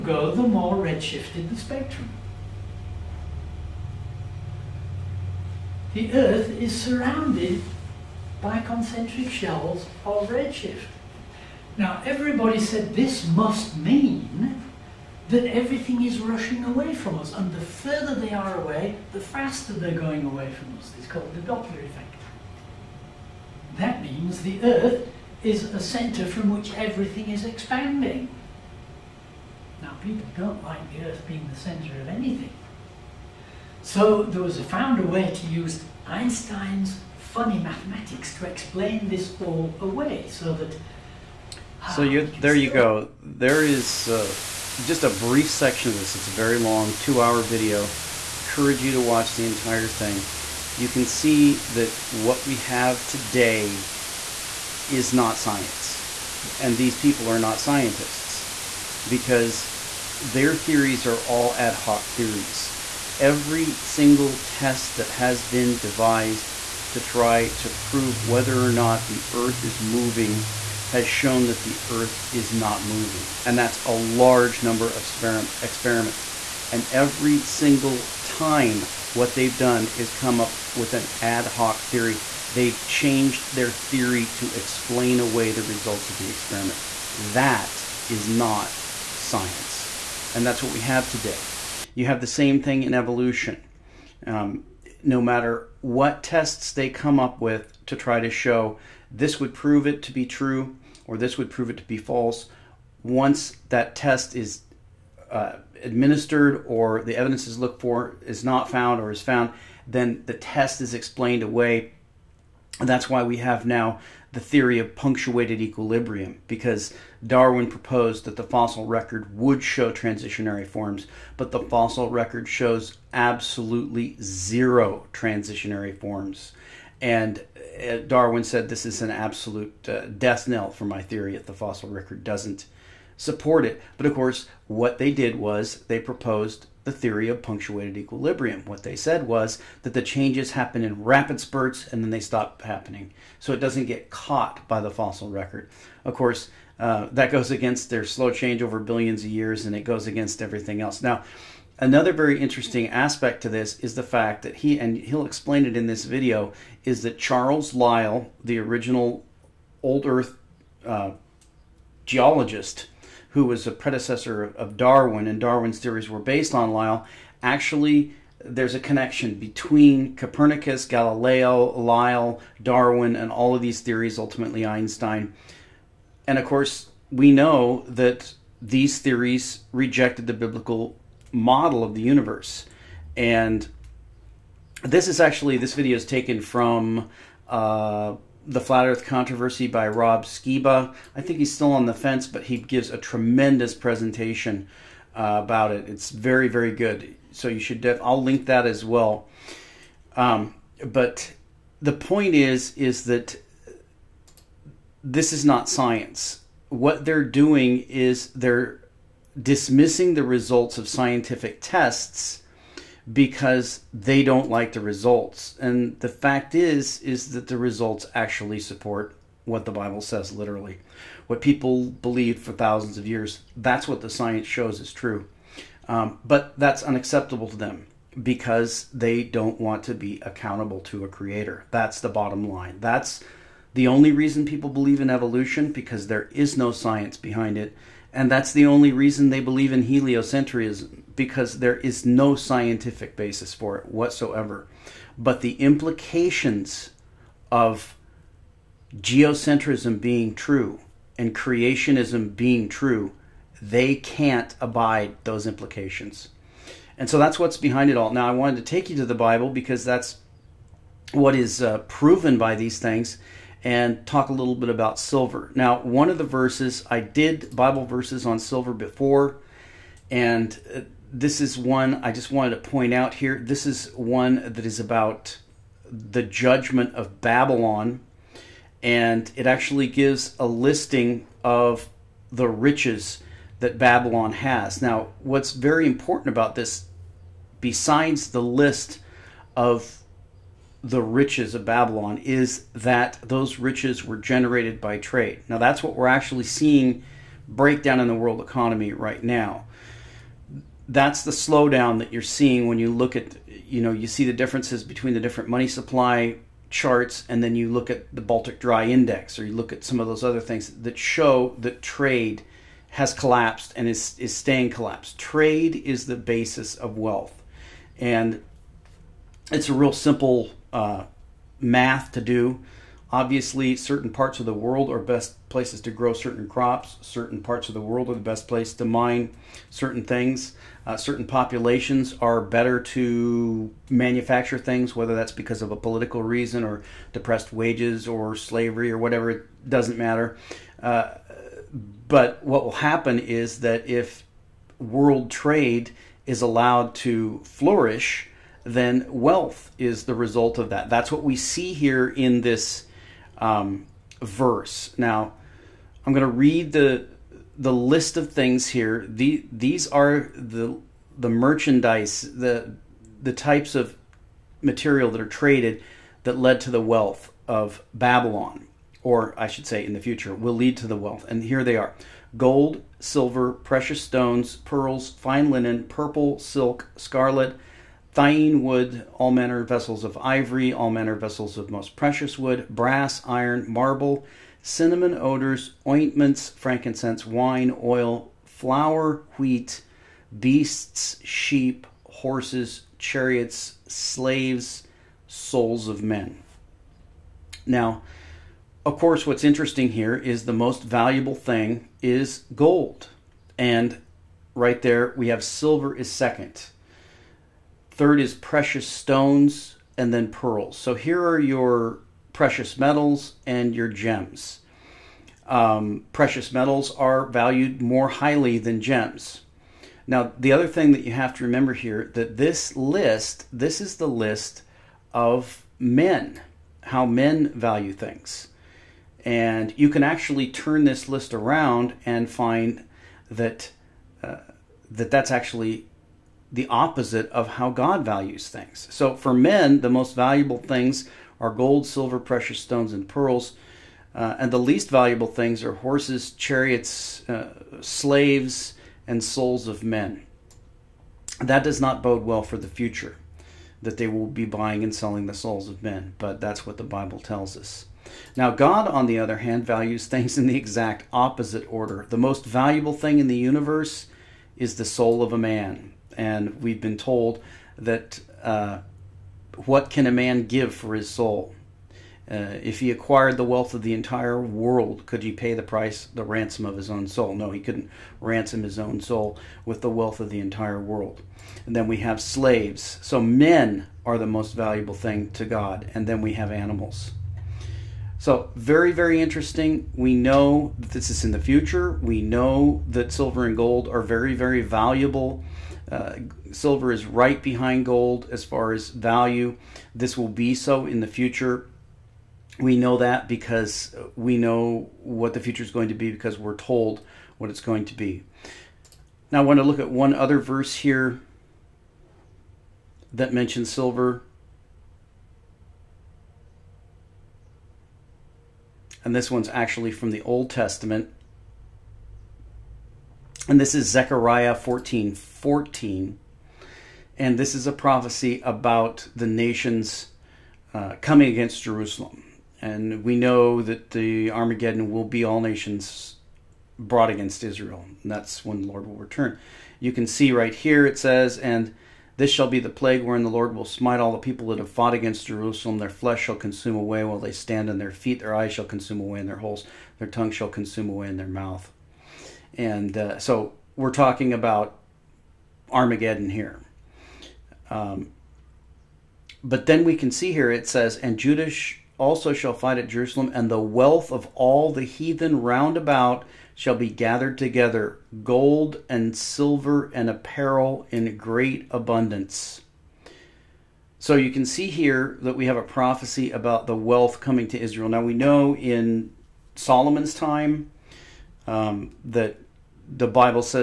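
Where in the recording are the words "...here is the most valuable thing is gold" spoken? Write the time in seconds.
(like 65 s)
399 s.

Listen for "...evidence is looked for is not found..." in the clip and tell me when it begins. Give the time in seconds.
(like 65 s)
107 s.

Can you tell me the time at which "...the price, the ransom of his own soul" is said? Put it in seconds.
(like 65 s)
475 s.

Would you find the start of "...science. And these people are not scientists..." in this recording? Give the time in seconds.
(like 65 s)
55 s.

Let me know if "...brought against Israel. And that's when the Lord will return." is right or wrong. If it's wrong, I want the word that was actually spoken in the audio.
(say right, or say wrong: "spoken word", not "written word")
right.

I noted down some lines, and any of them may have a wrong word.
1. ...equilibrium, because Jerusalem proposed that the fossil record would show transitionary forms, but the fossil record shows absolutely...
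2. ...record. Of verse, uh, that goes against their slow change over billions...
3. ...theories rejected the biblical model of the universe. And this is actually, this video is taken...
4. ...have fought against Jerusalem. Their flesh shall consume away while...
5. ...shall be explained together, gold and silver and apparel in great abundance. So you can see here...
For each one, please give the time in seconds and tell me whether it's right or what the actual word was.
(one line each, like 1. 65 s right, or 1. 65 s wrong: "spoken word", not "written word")
1. 115 s wrong: "Darwin", not "Jerusalem"
2. 145 s wrong: "course", not "verse"
3. 178 s right
4. 544 s right
5. 566 s wrong: "gathered", not "explained".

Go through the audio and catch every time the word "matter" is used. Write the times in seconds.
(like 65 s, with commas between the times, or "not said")
95 s, 339 s.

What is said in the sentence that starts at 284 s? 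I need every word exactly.
Now, what's very important about this, besides the list of the riches of Babylon is that those riches were generated by trade.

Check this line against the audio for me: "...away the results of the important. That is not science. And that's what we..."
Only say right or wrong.
wrong.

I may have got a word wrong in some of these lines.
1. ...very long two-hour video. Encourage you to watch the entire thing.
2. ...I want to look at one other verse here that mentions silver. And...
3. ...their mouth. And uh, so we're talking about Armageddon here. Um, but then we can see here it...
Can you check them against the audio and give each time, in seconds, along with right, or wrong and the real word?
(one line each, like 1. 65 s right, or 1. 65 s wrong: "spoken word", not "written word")
1. 46 s right
2. 509 s right
3. 551 s right.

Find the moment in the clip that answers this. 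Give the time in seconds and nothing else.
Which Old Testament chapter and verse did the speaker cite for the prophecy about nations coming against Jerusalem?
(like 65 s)
523 s.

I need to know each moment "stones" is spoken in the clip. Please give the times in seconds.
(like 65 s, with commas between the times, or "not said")
374 s, 408 s, 442 s.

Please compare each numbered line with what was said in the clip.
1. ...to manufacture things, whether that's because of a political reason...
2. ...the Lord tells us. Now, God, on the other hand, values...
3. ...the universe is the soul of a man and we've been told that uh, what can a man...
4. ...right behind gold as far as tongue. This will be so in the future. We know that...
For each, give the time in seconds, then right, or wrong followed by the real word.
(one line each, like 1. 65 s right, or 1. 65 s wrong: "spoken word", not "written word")
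1. 332 s right
2. 456 s wrong: "Bible", not "Lord"
3. 463 s right
4. 497 s wrong: "value", not "tongue".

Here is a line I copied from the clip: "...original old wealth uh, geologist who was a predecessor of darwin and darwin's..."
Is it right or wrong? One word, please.
wrong.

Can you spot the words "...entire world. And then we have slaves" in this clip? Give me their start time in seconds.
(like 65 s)
480 s.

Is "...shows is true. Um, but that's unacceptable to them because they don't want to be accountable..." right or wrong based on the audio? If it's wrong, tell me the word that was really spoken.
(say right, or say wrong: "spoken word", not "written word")
right.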